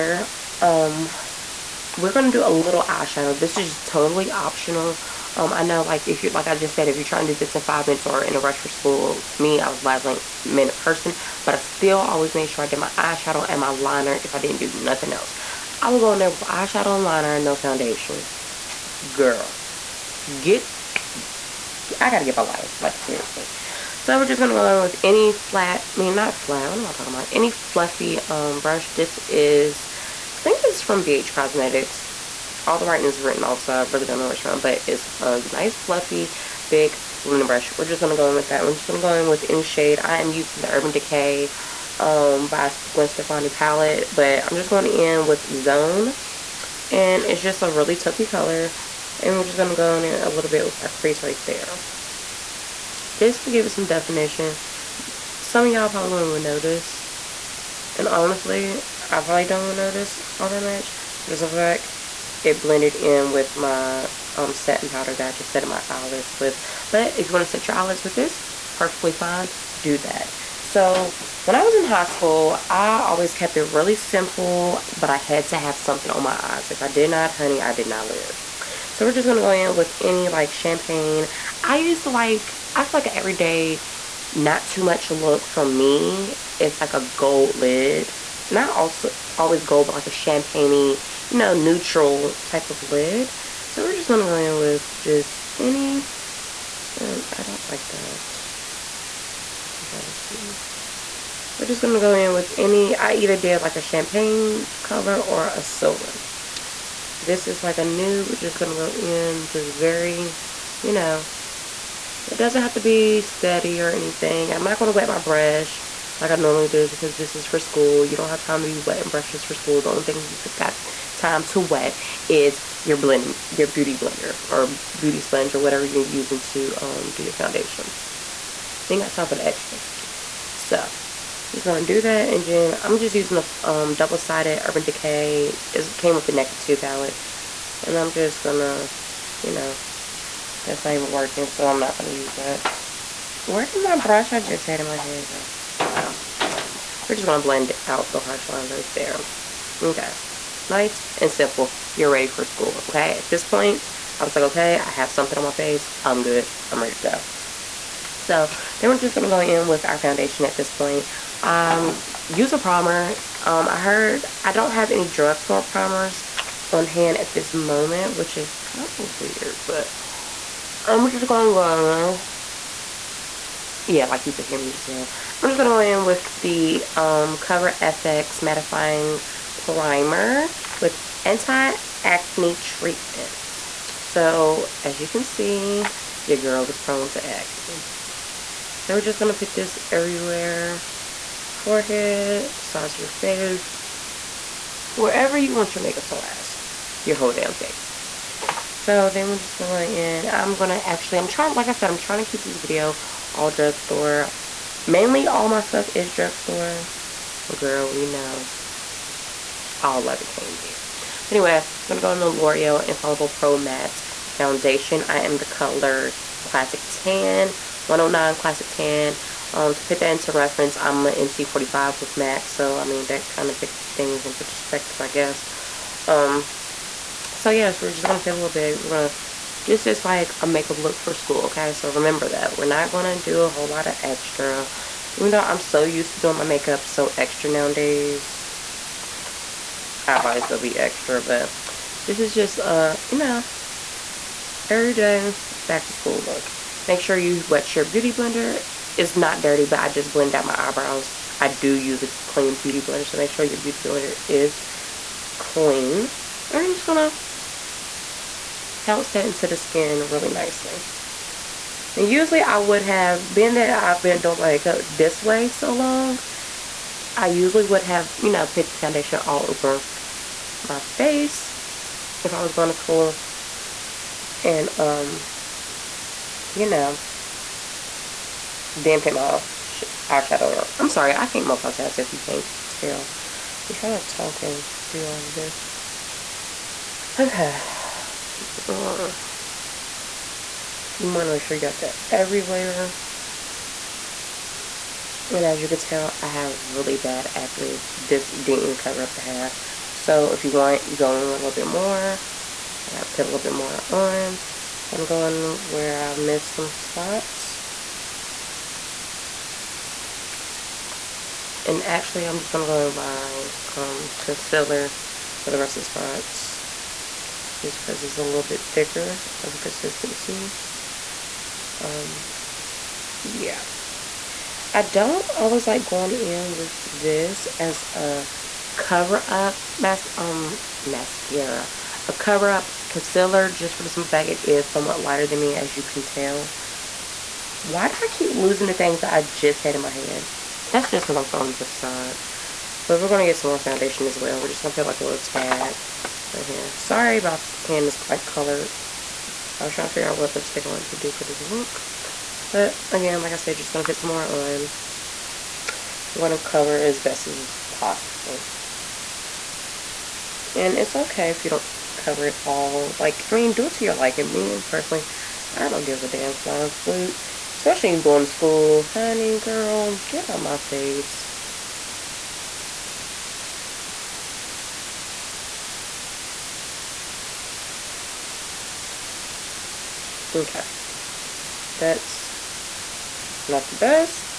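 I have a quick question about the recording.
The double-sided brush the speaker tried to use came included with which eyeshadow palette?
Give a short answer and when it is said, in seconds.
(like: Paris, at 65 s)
Naked Two, at 136 s.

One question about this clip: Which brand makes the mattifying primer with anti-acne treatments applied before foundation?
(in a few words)
Cover FX.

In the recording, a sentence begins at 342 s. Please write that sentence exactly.
But we're going to get some more foundation as well.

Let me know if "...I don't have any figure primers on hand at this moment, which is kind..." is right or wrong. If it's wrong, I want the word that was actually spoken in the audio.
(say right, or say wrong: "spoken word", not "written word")
wrong: "drugstore", not "figure".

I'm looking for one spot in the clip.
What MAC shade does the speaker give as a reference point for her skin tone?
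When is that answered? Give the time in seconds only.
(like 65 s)
221 s.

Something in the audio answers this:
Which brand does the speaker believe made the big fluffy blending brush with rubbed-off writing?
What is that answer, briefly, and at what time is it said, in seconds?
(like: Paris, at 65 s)
BH Cosmetics, at 31 s.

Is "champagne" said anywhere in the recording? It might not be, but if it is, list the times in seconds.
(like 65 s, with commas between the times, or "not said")
80 s, 90 s, 103 s.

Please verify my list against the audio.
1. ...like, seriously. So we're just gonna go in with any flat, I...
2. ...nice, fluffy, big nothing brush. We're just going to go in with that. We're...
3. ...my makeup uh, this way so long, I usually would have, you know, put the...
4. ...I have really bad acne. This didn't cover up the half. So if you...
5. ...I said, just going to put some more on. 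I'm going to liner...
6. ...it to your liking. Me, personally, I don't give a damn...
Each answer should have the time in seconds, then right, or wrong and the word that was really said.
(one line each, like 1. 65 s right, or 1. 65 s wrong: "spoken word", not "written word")
1. 22 s right
2. 35 s wrong: "blending", not "nothing"
3. 264 s right
4. 296 s right
5. 353 s wrong: "cover", not "liner"
6. 363 s right.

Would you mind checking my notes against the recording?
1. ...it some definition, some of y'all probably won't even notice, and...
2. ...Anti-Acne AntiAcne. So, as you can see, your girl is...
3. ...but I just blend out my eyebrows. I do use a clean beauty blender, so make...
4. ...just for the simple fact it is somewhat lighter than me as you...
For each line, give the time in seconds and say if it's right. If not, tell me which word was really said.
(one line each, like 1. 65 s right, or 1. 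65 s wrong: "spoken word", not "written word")
1. 53 s right
2. 181 s wrong: "Treatments", not "AntiAcne"
3. 249 s right
4. 333 s right.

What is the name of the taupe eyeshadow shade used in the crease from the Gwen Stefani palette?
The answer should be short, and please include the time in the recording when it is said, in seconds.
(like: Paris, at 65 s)
Zone, at 45 s.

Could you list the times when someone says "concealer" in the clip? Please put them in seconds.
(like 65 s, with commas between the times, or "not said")
314 s, 332 s.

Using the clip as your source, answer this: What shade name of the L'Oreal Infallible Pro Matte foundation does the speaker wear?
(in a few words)
109 Classic Tan.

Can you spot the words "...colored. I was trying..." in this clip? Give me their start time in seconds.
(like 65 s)
348 s.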